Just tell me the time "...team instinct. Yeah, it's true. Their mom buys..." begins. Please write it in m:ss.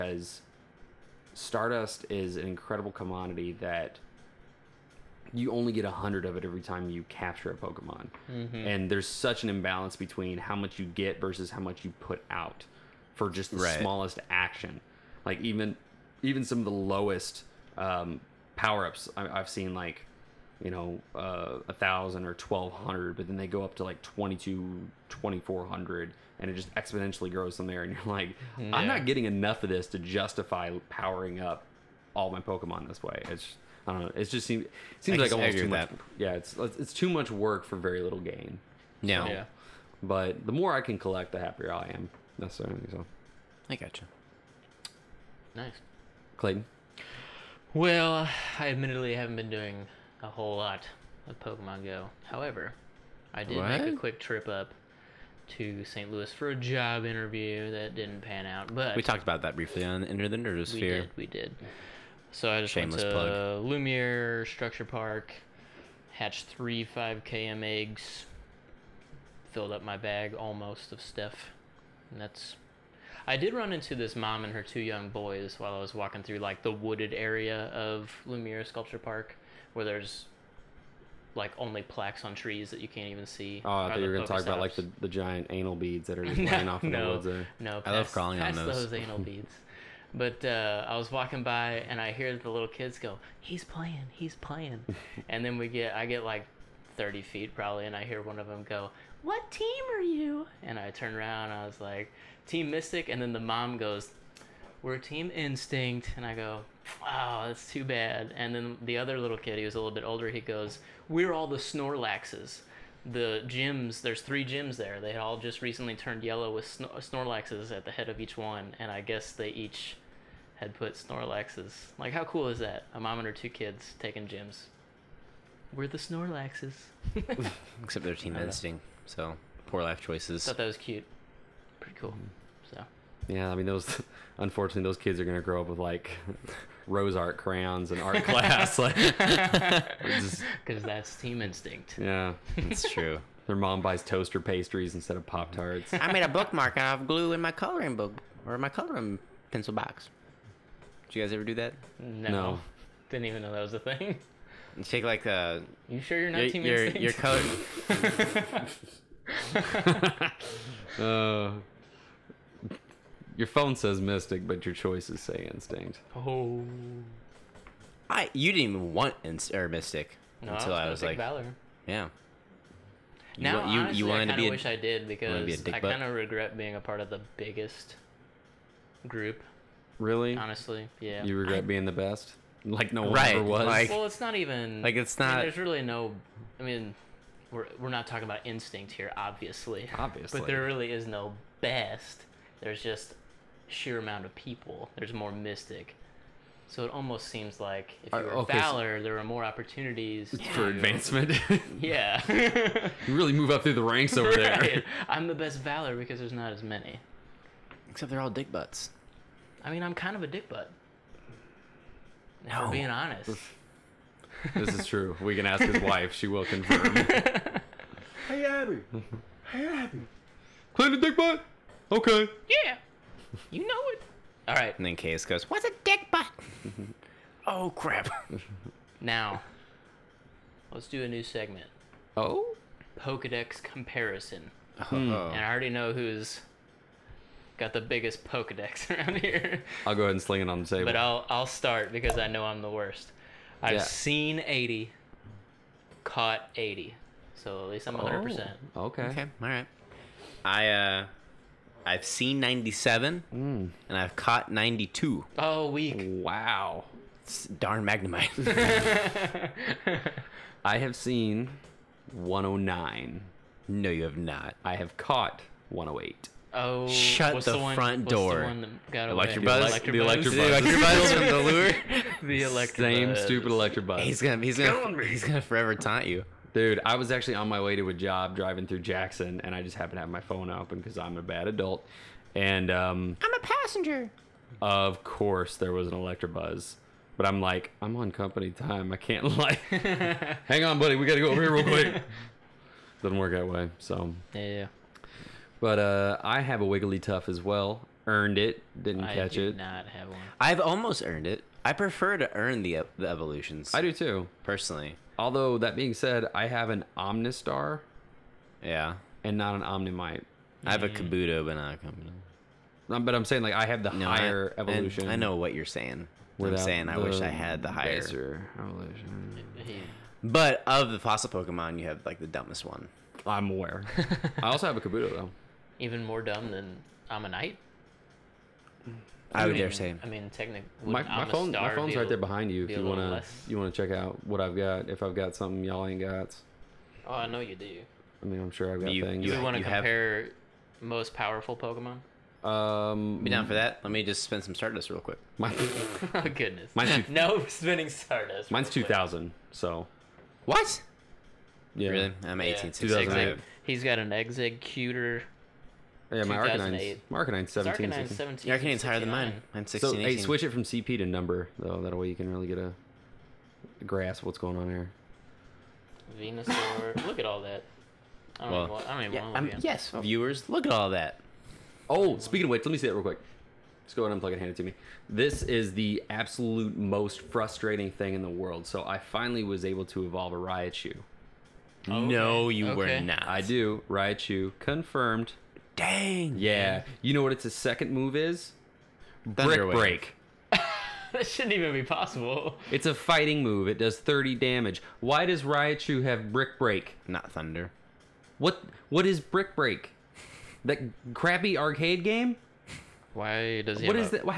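2:21.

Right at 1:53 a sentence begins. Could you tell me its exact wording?
The gyms, there's three gyms there.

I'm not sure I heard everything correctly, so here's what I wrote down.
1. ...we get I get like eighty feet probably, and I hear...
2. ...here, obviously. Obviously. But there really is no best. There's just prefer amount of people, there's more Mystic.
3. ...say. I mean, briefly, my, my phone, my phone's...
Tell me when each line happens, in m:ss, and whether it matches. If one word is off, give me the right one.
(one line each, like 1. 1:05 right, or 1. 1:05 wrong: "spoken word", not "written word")
1. 1:35 wrong: "thirty", not "eighty"
2. 3:08 wrong: "sheer", not "prefer"
3. 5:29 wrong: "technically", not "briefly".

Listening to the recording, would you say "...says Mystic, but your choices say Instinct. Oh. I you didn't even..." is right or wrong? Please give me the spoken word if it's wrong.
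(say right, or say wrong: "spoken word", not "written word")
right.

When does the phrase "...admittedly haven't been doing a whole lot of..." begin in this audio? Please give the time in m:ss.
0:48.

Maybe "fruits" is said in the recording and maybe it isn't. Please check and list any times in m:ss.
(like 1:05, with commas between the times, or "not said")
not said.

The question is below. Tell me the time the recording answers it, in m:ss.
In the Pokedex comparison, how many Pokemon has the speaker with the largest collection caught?
4:25.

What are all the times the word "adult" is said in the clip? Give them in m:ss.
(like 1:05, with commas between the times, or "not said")
4:41.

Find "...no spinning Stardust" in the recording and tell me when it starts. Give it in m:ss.
5:47.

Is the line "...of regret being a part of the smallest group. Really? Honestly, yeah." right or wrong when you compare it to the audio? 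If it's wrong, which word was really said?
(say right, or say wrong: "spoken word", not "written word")
wrong: "biggest", not "smallest".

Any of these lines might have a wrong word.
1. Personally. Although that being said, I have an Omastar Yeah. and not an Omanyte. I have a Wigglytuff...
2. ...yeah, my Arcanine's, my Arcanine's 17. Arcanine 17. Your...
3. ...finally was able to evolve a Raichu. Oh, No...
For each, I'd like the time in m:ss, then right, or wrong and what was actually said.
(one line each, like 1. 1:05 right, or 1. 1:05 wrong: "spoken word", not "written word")
1. 5:04 wrong: "Kabuto", not "Wigglytuff"
2. 5:56 right
3. 6:18 right.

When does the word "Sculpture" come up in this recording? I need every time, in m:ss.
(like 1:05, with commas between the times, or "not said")
1:04, 1:18.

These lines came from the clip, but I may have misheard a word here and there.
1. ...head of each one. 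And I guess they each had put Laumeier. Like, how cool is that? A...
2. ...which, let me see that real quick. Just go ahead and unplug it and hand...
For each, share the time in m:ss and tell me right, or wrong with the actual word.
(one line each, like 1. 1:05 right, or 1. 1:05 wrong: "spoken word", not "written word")
1. 1:57 wrong: "Snorlaxes", not "Laumeier"
2. 6:12 right.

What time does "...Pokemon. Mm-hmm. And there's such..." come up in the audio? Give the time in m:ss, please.
0:07.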